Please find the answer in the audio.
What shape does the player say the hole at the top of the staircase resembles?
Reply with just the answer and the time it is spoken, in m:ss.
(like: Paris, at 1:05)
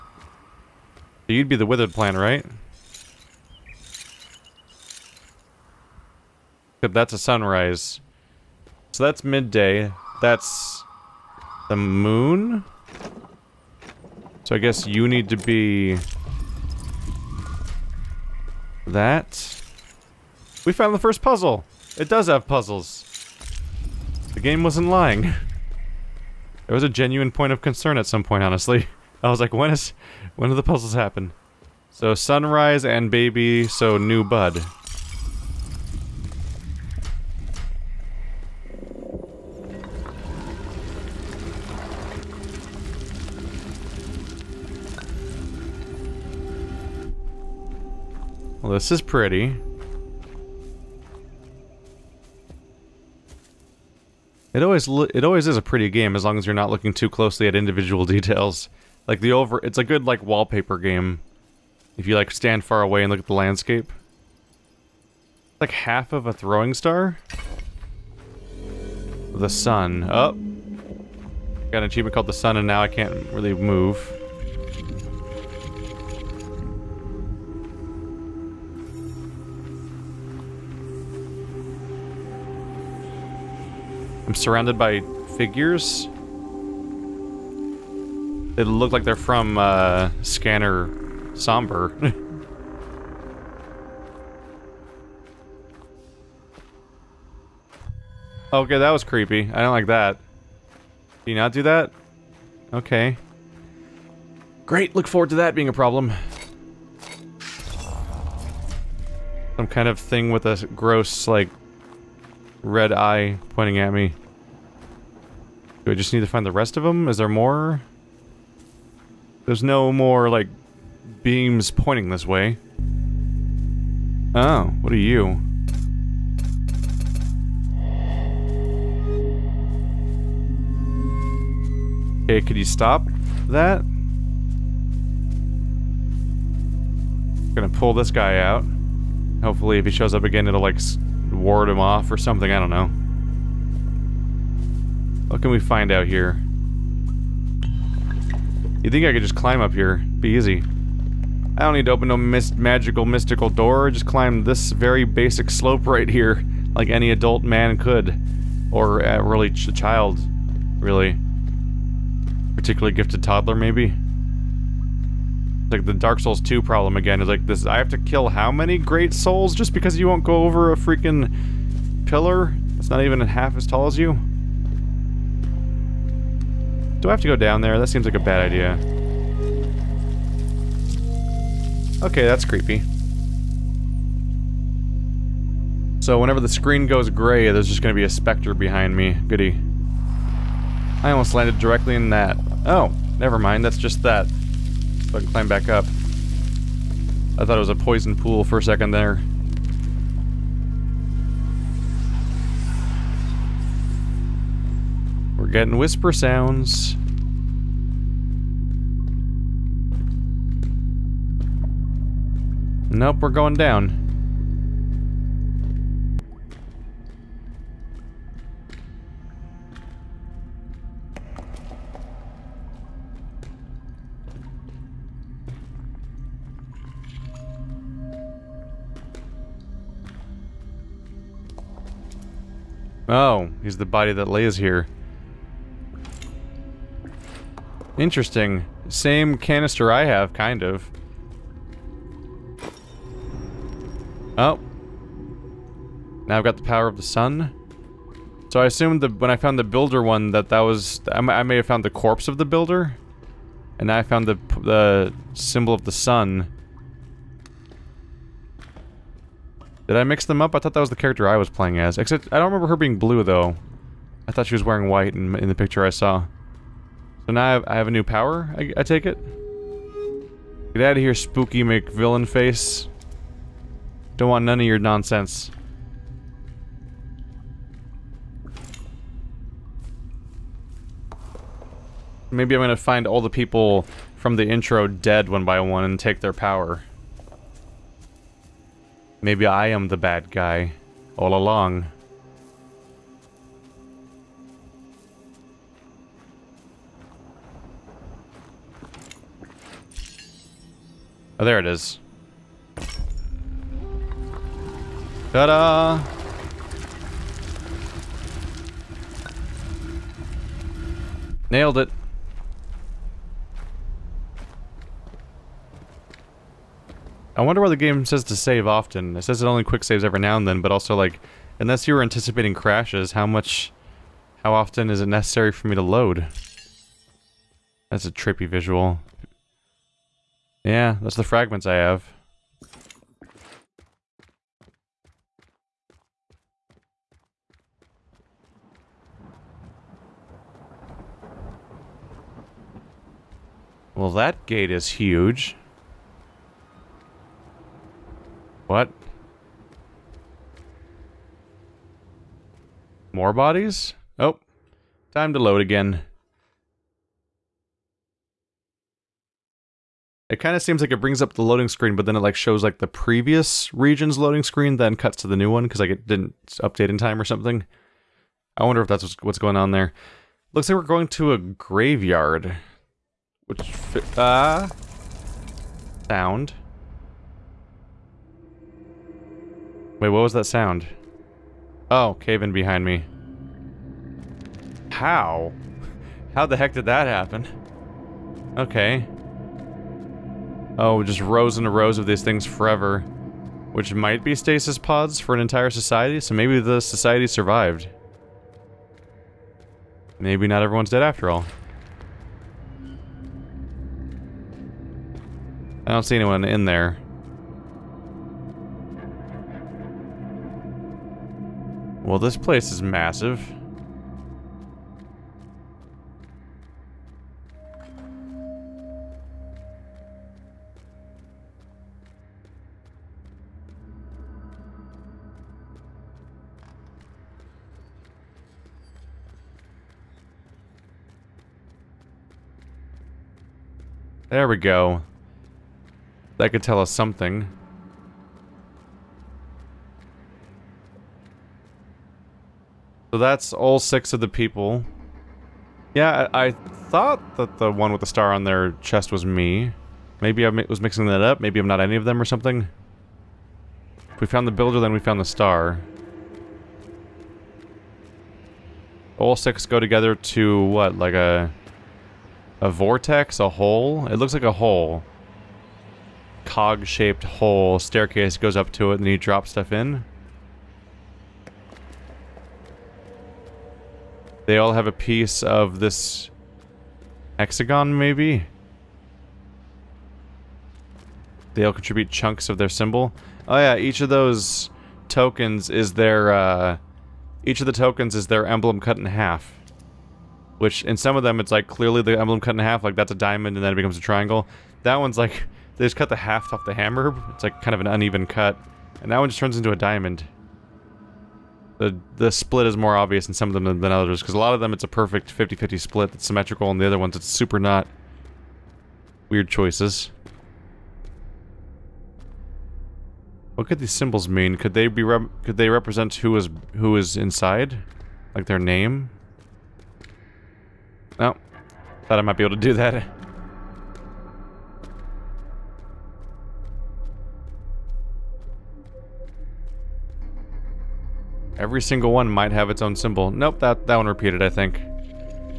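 Cog-shaped, at 7:46.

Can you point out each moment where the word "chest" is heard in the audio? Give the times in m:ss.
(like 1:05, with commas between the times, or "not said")
7:28.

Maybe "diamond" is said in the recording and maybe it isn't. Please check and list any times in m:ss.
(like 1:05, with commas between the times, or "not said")
8:13, 8:19.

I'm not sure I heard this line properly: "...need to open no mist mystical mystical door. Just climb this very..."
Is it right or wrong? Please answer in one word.
wrong.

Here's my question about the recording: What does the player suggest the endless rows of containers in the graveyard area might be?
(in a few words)
stasis pods.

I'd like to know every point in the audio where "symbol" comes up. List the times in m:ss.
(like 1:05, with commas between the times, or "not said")
4:15, 8:02, 8:33, 8:52.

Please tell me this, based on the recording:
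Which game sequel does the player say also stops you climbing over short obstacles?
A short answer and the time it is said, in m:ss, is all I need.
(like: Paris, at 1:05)
Dark Souls 2, at 2:45.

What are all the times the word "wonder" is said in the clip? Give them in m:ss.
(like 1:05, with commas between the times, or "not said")
5:17, 6:08.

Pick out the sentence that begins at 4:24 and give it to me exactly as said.
I thought she was wearing white in, in the picture I saw.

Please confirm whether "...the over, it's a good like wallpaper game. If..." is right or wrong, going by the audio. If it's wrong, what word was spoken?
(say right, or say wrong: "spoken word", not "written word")
right.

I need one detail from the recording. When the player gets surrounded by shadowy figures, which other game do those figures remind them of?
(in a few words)
Scanner Sombre.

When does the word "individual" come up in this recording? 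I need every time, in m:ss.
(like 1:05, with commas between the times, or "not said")
0:57.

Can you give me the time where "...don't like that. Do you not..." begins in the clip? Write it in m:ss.
1:39.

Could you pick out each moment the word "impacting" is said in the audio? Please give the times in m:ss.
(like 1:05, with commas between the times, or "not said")
not said.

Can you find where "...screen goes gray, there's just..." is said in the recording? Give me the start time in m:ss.
3:06.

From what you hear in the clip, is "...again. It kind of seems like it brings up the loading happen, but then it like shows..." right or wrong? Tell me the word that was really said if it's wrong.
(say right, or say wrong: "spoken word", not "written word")
wrong: "screen", not "happen".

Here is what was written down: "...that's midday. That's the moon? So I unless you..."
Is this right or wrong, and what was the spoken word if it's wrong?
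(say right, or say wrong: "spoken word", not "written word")
wrong: "guess", not "unless".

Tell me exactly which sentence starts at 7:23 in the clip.
So that's all six of the people.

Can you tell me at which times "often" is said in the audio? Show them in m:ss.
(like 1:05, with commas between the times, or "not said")
5:18, 5:24.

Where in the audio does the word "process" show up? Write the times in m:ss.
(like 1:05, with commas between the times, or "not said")
not said.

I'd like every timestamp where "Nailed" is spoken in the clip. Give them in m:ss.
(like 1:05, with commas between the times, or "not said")
5:11.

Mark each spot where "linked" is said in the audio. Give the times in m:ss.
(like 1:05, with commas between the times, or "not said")
not said.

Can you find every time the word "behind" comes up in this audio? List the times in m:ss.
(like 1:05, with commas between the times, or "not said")
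3:08, 6:22.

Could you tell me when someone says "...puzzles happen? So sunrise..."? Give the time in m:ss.
0:30.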